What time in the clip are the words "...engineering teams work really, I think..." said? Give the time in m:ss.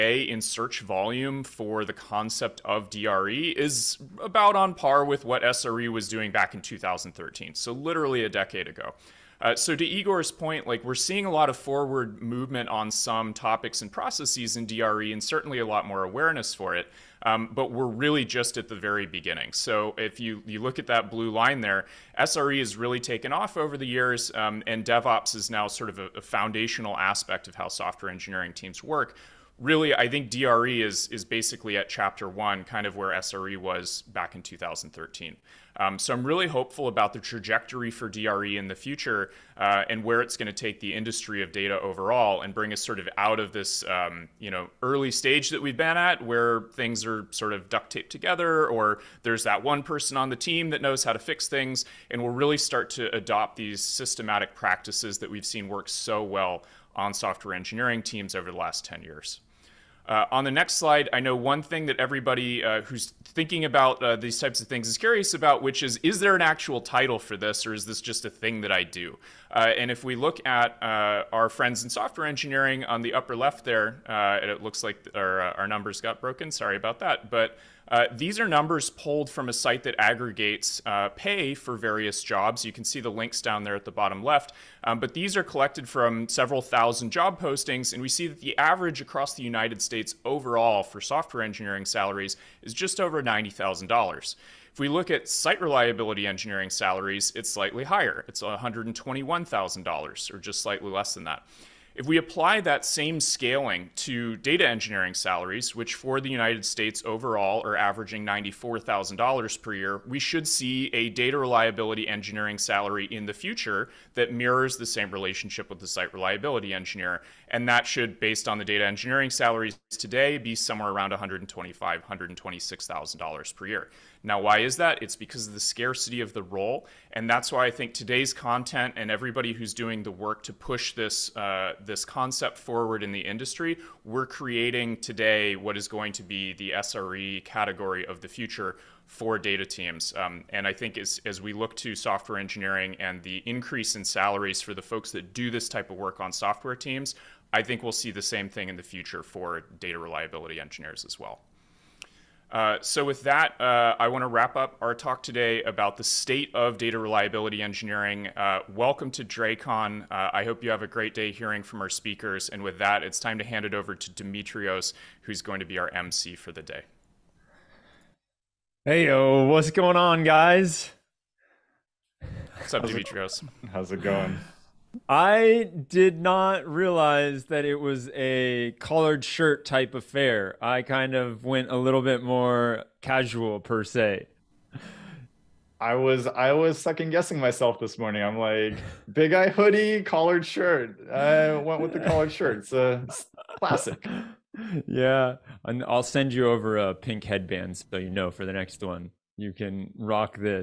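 0:28.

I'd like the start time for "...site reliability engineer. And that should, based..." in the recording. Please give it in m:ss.
1:55.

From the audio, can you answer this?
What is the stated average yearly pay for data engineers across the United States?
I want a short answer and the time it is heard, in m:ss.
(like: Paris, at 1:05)
$94,000, at 1:48.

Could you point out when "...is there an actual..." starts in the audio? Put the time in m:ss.
1:06.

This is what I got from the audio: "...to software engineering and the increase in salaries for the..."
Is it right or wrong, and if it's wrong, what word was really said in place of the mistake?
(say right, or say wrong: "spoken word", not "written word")
right.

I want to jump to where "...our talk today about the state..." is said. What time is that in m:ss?
2:34.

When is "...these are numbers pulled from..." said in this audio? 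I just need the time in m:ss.
1:18.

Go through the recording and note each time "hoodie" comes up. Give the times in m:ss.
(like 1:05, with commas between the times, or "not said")
3:09.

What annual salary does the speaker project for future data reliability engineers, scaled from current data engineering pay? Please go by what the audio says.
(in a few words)
$126,000.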